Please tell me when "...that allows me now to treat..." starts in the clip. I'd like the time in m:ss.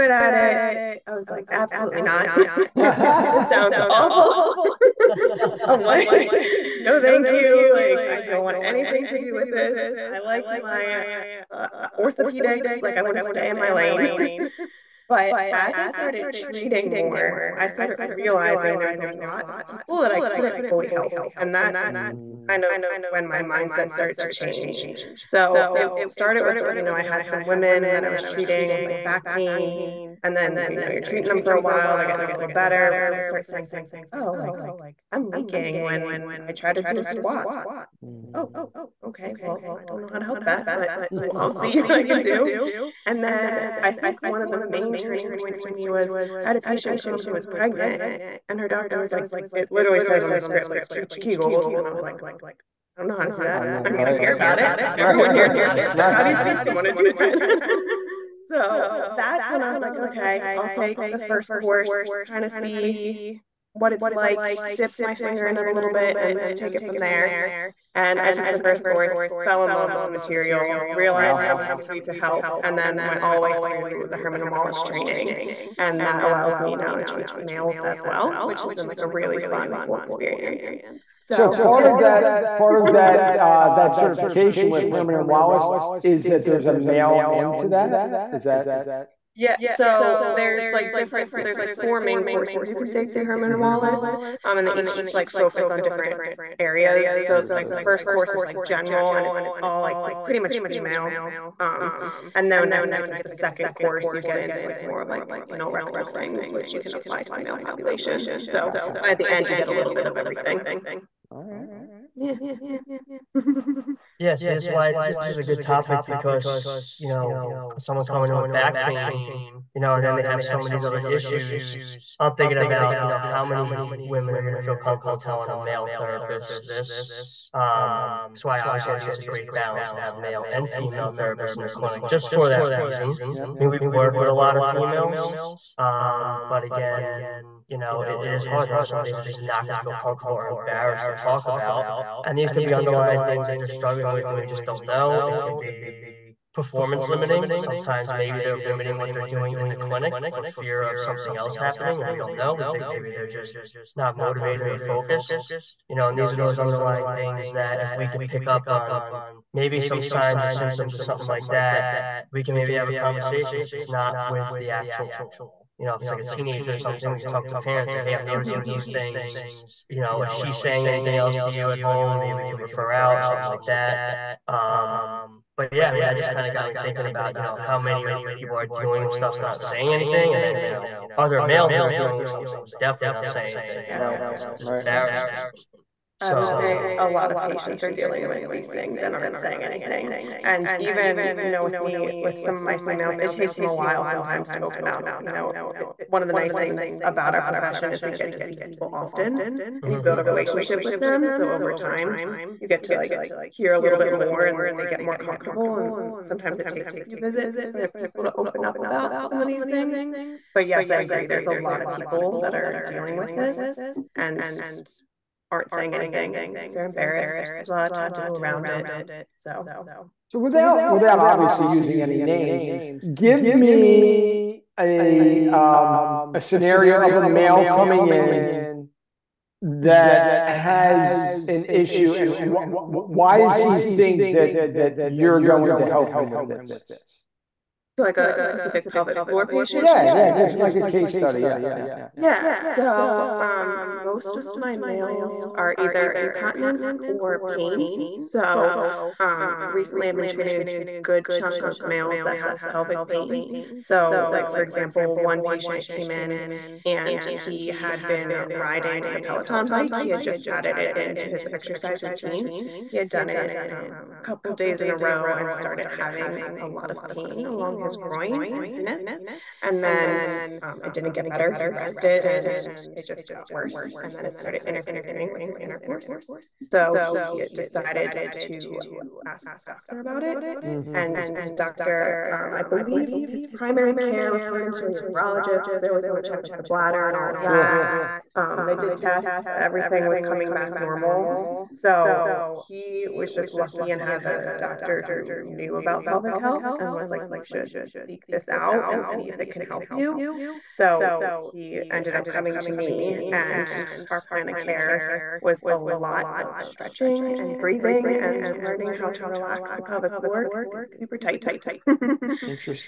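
1:16.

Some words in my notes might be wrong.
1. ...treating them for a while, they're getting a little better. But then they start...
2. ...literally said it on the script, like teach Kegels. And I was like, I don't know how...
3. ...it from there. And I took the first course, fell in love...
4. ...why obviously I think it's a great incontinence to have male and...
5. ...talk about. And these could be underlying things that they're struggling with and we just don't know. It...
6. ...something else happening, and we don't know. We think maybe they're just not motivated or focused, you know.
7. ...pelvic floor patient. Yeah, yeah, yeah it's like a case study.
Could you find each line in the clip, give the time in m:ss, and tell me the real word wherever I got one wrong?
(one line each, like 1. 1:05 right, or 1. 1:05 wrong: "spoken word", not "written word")
1. 0:31 right
2. 0:49 right
3. 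1:06 right
4. 2:08 wrong: "balance", not "incontinence"
5. 2:21 right
6. 2:30 right
7. 3:58 right.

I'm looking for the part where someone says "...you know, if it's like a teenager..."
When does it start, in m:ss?
2:45.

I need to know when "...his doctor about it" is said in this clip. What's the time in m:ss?
4:39.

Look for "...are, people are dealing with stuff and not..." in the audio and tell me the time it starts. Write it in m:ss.
2:58.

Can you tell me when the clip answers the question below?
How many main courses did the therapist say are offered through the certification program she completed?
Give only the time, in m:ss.
1:31.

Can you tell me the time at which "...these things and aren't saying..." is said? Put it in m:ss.
3:08.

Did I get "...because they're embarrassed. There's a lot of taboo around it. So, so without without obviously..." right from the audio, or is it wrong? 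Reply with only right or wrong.
right.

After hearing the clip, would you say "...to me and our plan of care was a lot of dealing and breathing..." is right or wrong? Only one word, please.
wrong.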